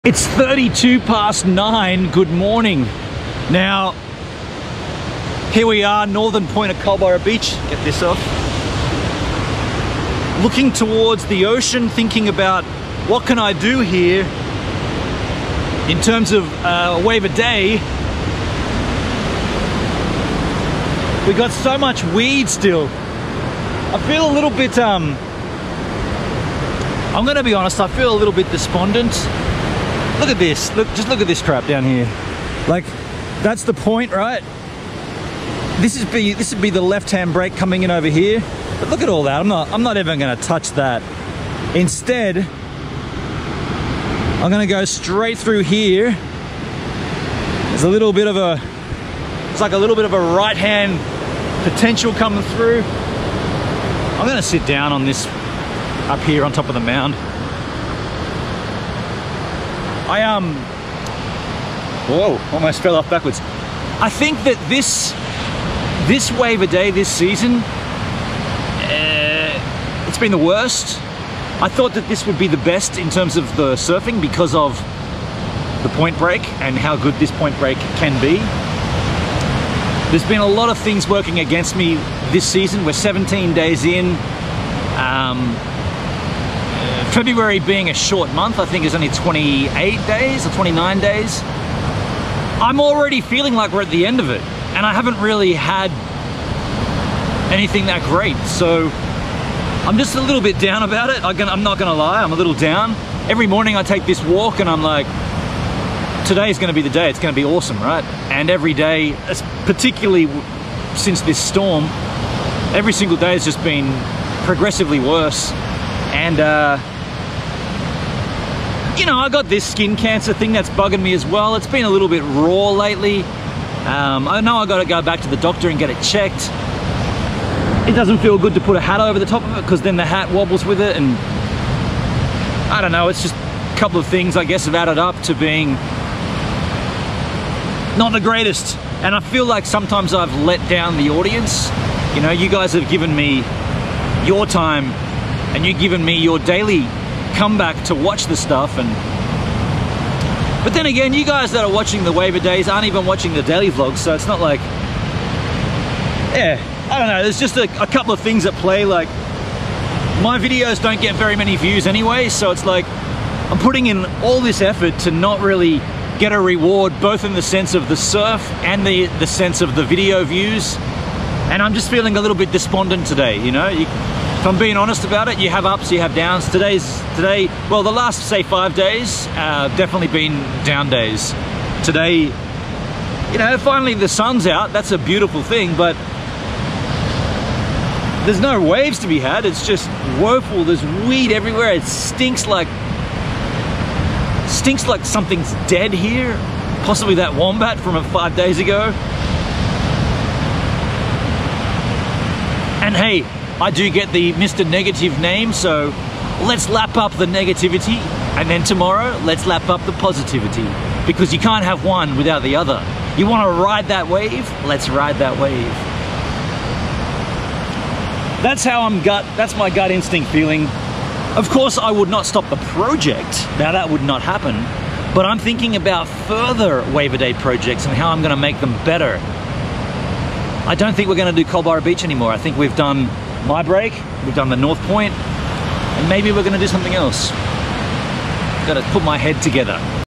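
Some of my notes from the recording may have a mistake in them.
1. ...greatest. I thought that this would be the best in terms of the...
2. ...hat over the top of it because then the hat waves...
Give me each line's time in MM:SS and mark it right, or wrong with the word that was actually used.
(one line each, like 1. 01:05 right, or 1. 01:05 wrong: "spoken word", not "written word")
1. 01:10 wrong: "worst", not "greatest"
2. 02:08 wrong: "wobbles", not "waves".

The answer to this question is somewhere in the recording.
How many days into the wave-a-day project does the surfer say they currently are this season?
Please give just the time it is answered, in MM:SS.
01:22.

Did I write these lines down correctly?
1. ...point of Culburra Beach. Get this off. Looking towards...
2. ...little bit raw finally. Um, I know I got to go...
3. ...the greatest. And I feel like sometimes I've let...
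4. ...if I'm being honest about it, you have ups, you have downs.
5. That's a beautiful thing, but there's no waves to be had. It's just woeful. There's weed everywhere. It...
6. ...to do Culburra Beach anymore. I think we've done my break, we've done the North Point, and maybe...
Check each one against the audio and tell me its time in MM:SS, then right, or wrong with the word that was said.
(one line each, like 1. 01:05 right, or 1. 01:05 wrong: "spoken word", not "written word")
1. 00:06 right
2. 02:01 wrong: "lately", not "finally"
3. 02:18 right
4. 02:54 right
5. 03:04 right
6. 03:51 right.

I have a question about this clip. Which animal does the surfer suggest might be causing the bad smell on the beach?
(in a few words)
wombat.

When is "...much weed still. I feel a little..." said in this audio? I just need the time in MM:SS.
00:21.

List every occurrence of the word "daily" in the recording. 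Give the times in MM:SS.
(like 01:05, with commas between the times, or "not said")
02:26, 02:33.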